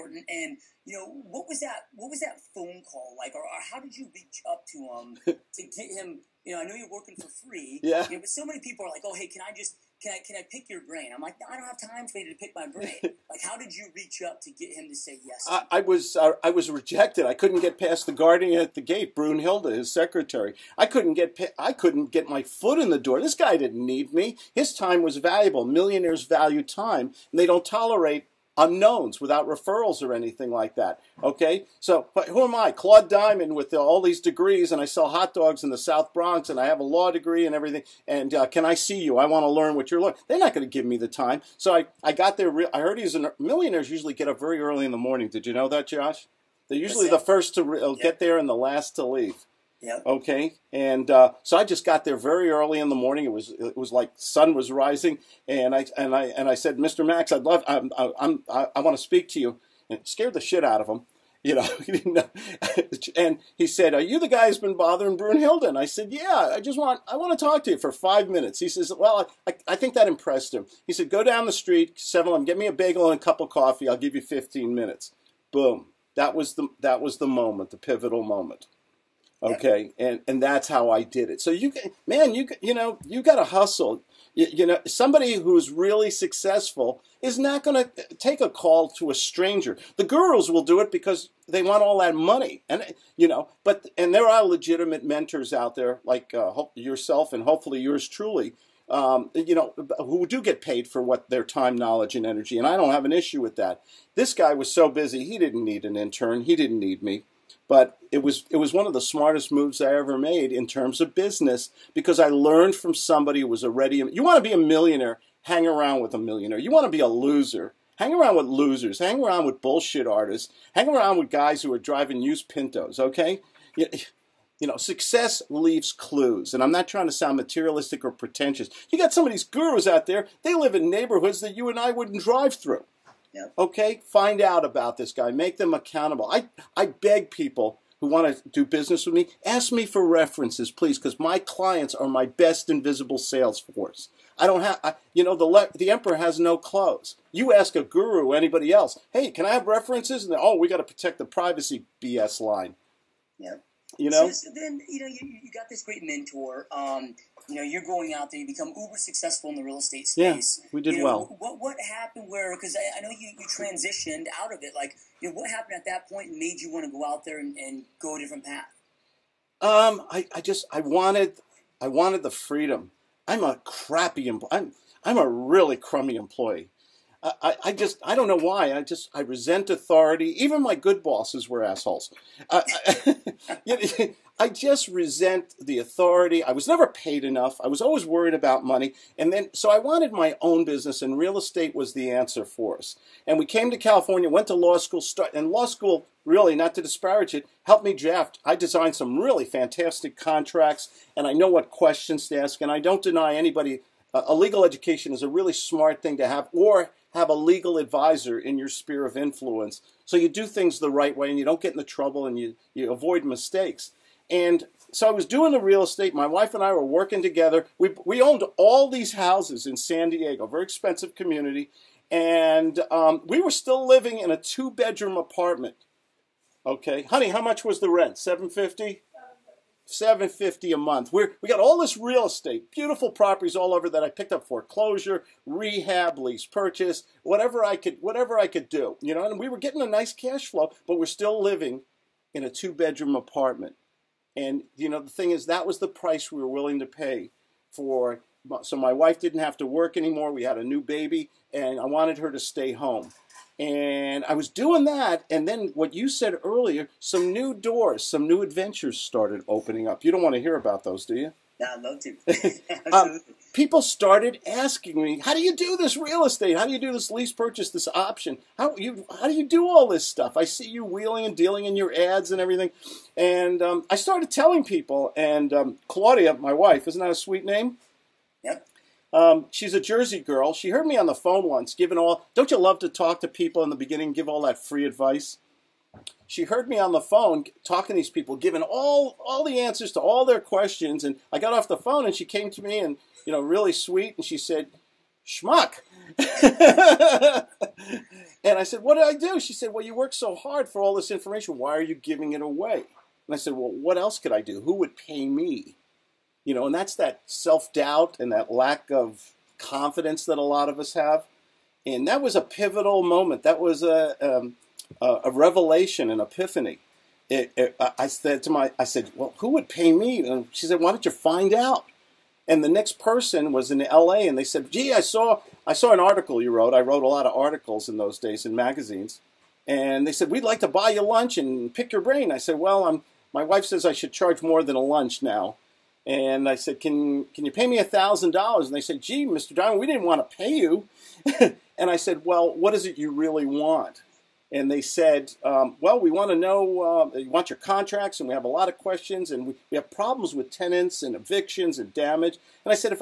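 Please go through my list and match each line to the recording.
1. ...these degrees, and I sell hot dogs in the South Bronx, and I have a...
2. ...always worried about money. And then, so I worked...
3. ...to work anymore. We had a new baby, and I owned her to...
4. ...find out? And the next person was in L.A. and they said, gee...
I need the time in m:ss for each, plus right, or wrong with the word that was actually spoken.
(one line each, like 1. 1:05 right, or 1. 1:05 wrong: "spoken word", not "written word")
1. 0:34 right
2. 3:07 wrong: "wanted", not "worked"
3. 4:09 wrong: "wanted", not "owned"
4. 5:21 right.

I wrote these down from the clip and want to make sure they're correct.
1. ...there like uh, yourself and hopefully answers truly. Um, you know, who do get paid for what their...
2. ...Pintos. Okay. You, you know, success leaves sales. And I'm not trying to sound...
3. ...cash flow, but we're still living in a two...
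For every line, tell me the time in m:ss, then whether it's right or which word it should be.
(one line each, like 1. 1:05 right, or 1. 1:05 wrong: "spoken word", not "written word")
1. 1:35 wrong: "yours", not "answers"
2. 2:02 wrong: "clues", not "sales"
3. 4:00 right.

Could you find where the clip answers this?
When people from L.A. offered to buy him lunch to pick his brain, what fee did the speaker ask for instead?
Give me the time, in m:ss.
5:37.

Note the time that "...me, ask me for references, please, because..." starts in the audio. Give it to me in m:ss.
2:19.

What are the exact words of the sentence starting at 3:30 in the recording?
So you do things the right way and you don't get into trouble and you, you avoid mistakes.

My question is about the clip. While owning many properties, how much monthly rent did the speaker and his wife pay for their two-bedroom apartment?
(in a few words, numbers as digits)
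$750.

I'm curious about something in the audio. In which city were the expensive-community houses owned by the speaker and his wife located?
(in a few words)
San Diego.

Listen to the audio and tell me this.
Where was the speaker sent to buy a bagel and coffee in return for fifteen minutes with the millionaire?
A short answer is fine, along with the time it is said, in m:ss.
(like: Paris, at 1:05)
Seven Eleven, at 1:12.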